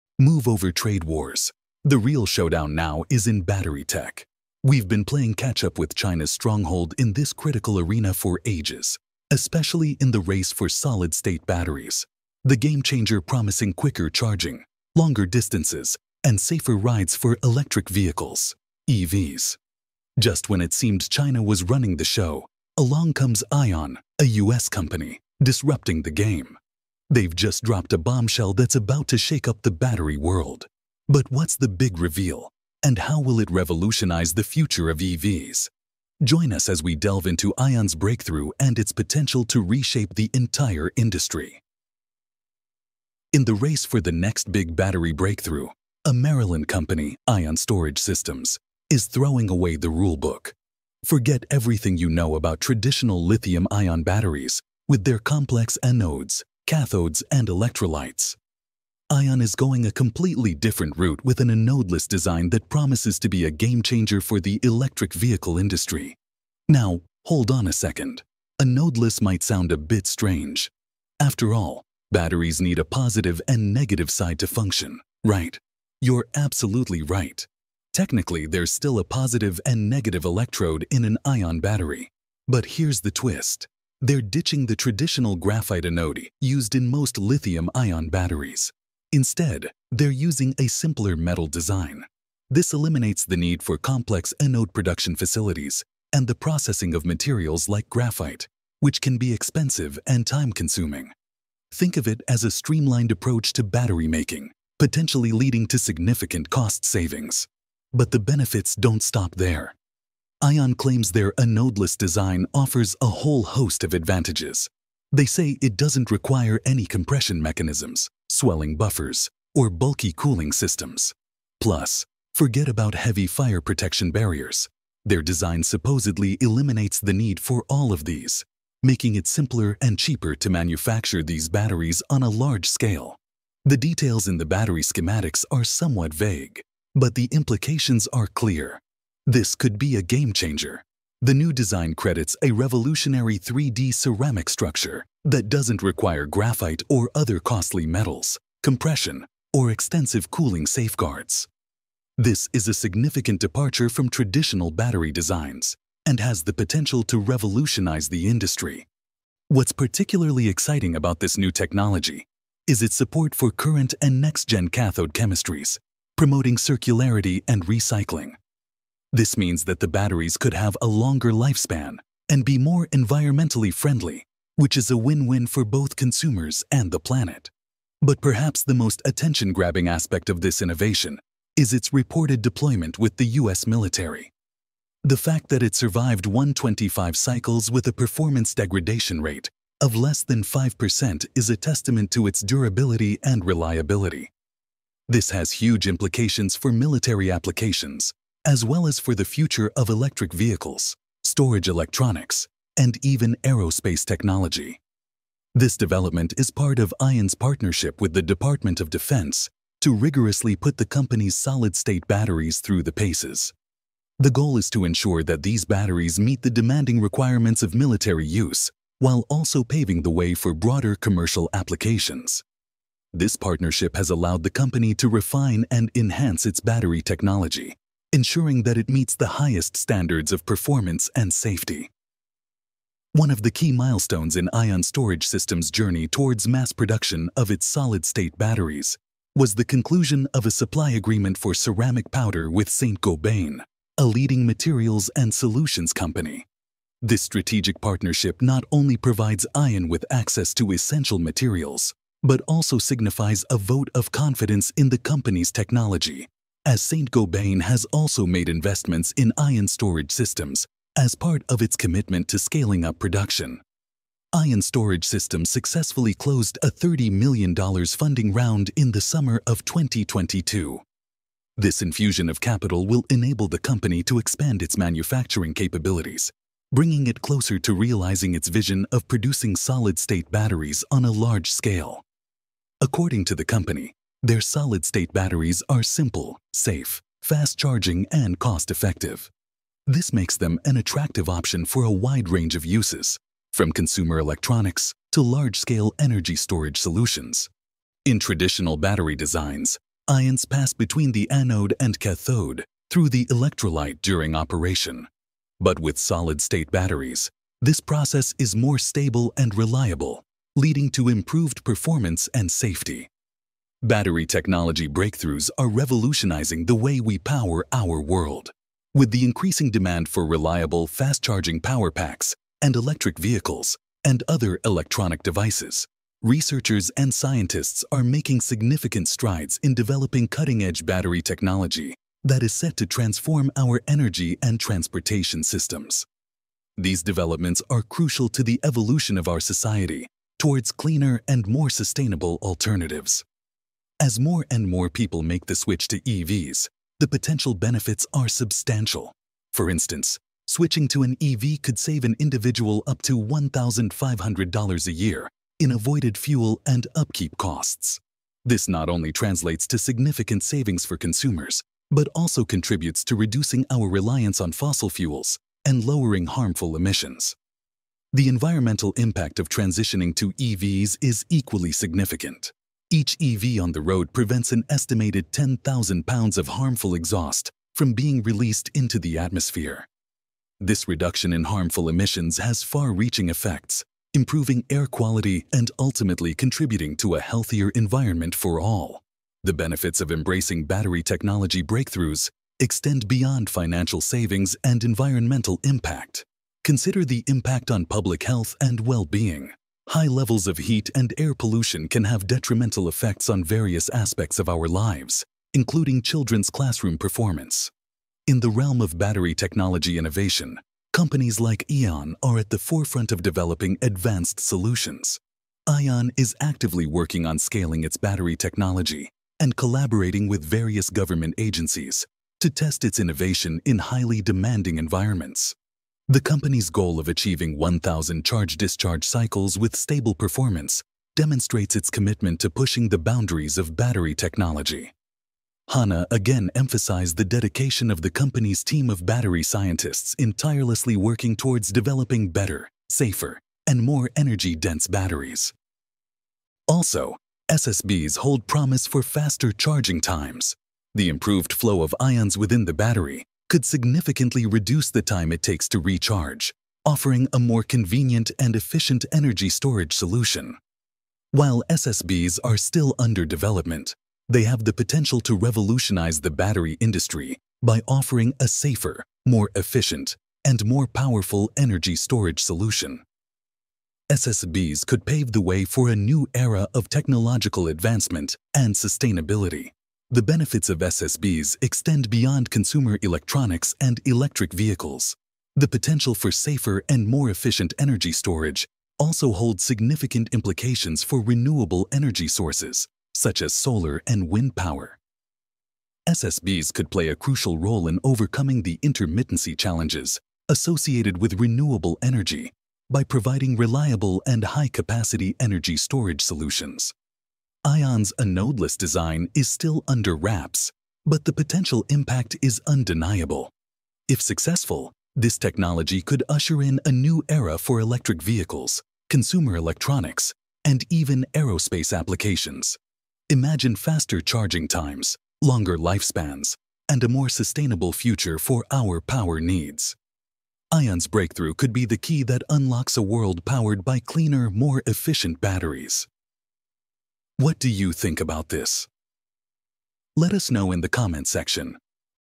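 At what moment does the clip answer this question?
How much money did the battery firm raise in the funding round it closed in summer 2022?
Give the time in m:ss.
4:26.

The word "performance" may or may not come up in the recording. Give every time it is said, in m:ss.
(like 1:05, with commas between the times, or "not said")
3:07, 3:50, 5:11, 6:46, 7:10.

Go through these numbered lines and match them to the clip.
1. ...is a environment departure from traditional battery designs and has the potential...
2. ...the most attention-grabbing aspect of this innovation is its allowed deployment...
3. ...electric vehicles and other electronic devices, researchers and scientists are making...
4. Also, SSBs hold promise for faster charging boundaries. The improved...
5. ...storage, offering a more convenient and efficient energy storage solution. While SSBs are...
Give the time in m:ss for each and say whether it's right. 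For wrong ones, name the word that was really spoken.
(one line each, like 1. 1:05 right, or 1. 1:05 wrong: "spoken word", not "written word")
1. 2:32 wrong: "significant", not "environment"
2. 2:58 wrong: "reported", not "allowed"
3. 5:22 right
4. 7:26 wrong: "times", not "boundaries"
5. 7:35 wrong: "recharge", not "storage".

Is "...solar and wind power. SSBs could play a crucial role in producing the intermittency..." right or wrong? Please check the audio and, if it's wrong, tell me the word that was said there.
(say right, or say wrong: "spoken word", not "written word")
wrong: "overcoming", not "producing".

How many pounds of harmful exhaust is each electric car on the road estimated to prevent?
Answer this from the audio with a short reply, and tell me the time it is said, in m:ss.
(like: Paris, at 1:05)
10,000 pounds, at 6:15.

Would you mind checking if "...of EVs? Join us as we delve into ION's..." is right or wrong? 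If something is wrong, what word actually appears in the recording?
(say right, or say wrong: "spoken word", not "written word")
right.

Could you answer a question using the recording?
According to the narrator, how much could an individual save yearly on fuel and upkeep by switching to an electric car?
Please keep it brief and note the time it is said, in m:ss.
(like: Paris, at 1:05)
$1,500, at 5:53.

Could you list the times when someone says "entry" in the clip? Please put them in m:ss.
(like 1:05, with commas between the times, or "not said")
not said.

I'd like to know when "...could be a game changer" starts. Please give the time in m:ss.
2:19.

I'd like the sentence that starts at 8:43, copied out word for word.
Imagine faster charging times, longer lifespans, and a more sustainable future for our power needs.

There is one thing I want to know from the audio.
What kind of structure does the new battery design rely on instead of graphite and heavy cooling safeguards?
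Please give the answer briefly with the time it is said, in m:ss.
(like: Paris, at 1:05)
3D ceramic structure, at 2:23.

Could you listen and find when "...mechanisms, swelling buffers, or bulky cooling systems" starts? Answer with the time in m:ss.
1:57.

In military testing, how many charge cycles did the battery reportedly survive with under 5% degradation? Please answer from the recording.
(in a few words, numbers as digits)
125.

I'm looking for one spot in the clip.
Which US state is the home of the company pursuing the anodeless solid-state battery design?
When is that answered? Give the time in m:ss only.
0:46.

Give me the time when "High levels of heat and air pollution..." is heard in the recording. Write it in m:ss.
6:39.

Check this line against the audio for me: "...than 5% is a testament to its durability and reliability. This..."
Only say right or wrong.
right.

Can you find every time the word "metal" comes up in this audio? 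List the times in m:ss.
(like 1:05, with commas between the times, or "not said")
1:31, 2:27.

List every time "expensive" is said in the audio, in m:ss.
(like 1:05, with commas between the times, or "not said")
1:39.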